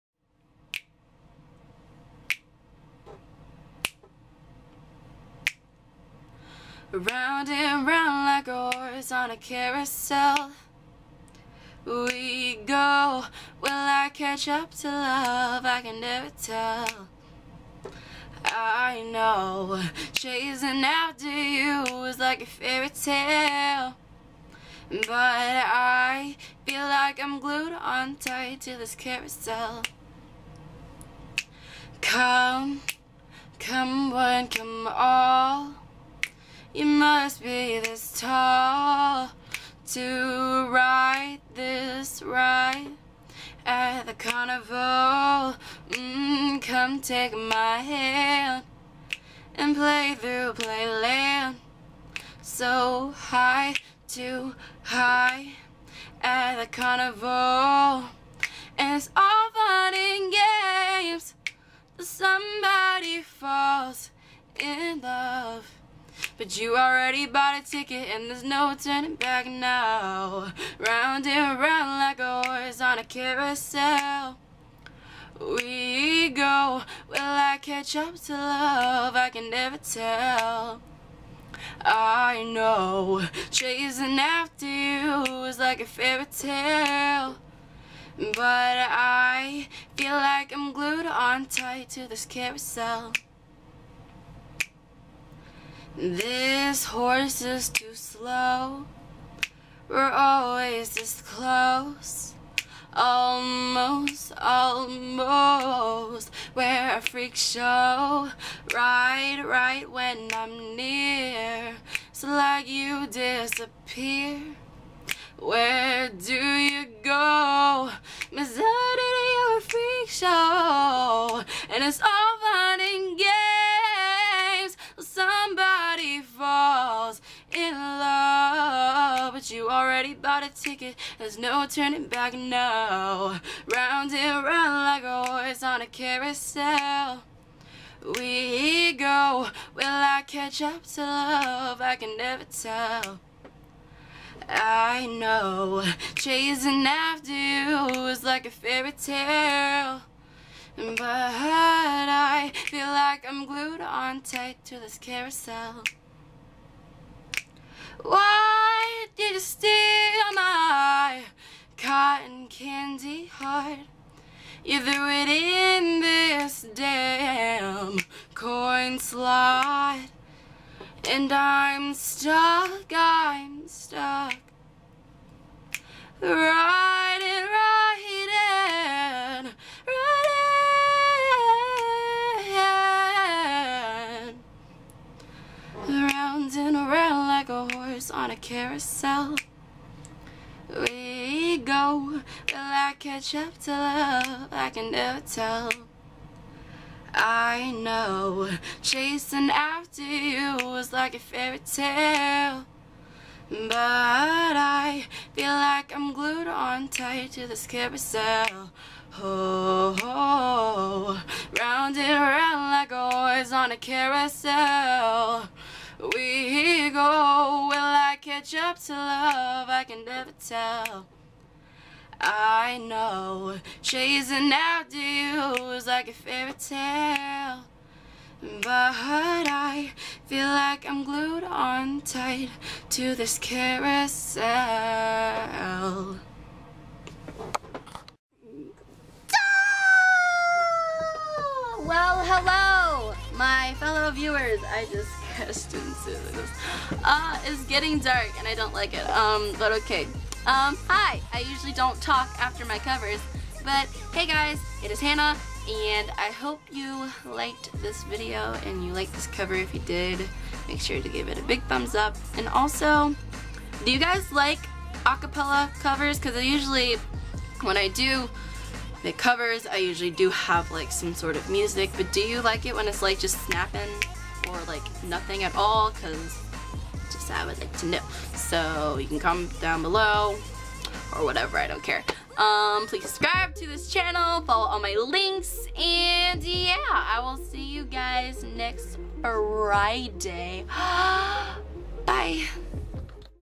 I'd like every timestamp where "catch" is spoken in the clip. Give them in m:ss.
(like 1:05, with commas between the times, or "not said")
0:14, 1:17, 2:20, 3:12, 3:38.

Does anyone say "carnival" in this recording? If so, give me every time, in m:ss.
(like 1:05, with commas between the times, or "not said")
0:44, 0:56.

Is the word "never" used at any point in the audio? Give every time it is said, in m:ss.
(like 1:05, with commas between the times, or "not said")
0:16, 1:19, 2:22, 3:14, 3:40.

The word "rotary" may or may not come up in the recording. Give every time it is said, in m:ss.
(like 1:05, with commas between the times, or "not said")
not said.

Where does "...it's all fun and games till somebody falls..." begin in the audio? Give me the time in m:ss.
0:58.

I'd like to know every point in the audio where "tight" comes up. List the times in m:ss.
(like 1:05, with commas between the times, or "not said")
0:28, 1:31, 2:34, 3:26, 3:52.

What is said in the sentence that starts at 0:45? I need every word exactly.
Mm, come take my hand and play through playland.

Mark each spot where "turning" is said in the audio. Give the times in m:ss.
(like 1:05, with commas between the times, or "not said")
1:08, 2:11.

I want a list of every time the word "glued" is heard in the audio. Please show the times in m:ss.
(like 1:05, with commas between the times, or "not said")
0:27, 1:30, 2:33, 3:26, 3:51.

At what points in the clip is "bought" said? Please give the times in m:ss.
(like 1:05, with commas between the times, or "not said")
1:07, 2:10.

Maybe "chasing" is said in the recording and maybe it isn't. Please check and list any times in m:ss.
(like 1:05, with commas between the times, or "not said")
0:20, 1:23, 2:26, 3:18, 3:43.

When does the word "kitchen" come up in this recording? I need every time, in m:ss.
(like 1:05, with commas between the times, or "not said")
not said.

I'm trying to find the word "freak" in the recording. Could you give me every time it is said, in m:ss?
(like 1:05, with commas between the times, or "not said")
1:47, 1:59.